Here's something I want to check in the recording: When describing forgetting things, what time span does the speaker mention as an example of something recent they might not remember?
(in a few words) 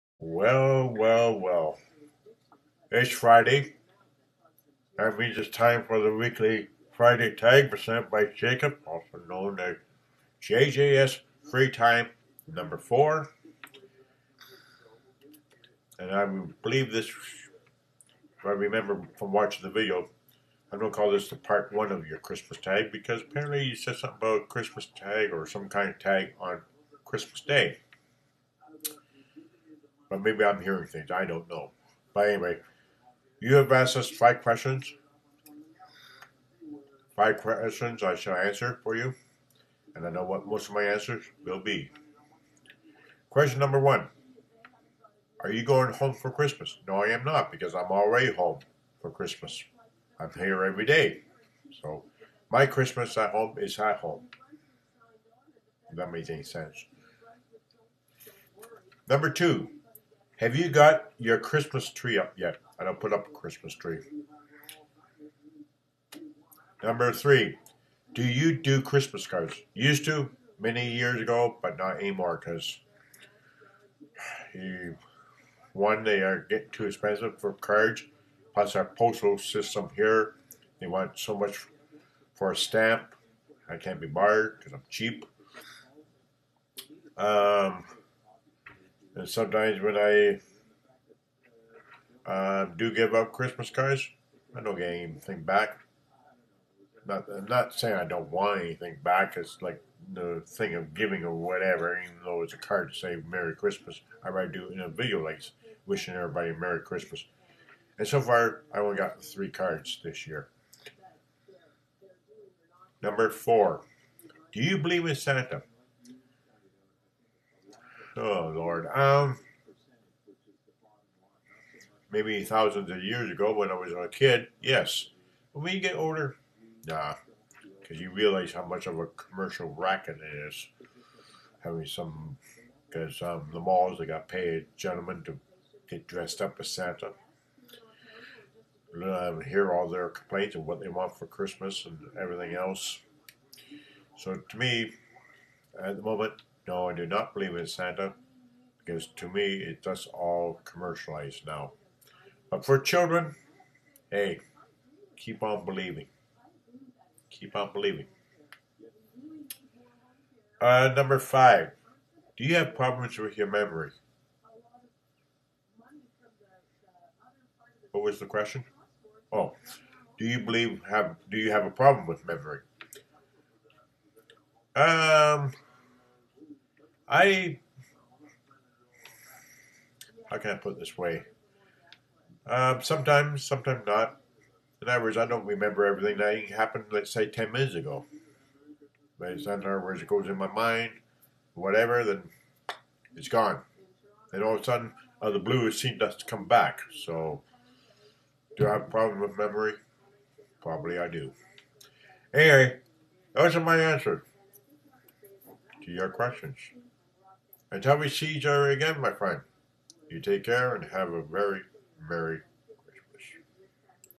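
10 minutes ago.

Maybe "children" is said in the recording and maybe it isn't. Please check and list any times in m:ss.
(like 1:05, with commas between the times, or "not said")
2:32.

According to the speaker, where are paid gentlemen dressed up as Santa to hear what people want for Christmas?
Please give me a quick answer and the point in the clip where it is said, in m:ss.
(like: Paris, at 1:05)
The malls, at 2:13.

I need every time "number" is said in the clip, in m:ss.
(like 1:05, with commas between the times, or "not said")
0:12, 0:43, 0:59, 1:06, 1:53, 2:40.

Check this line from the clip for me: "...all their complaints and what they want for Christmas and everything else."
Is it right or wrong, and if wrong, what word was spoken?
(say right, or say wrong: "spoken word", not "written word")
right.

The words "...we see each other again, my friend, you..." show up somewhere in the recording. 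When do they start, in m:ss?
3:27.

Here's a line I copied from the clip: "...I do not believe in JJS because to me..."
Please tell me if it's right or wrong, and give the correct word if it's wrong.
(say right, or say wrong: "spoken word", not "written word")
wrong: "Santa", not "JJS".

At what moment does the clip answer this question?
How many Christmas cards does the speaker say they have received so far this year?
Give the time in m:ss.
1:49.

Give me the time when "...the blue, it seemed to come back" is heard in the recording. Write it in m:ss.
3:15.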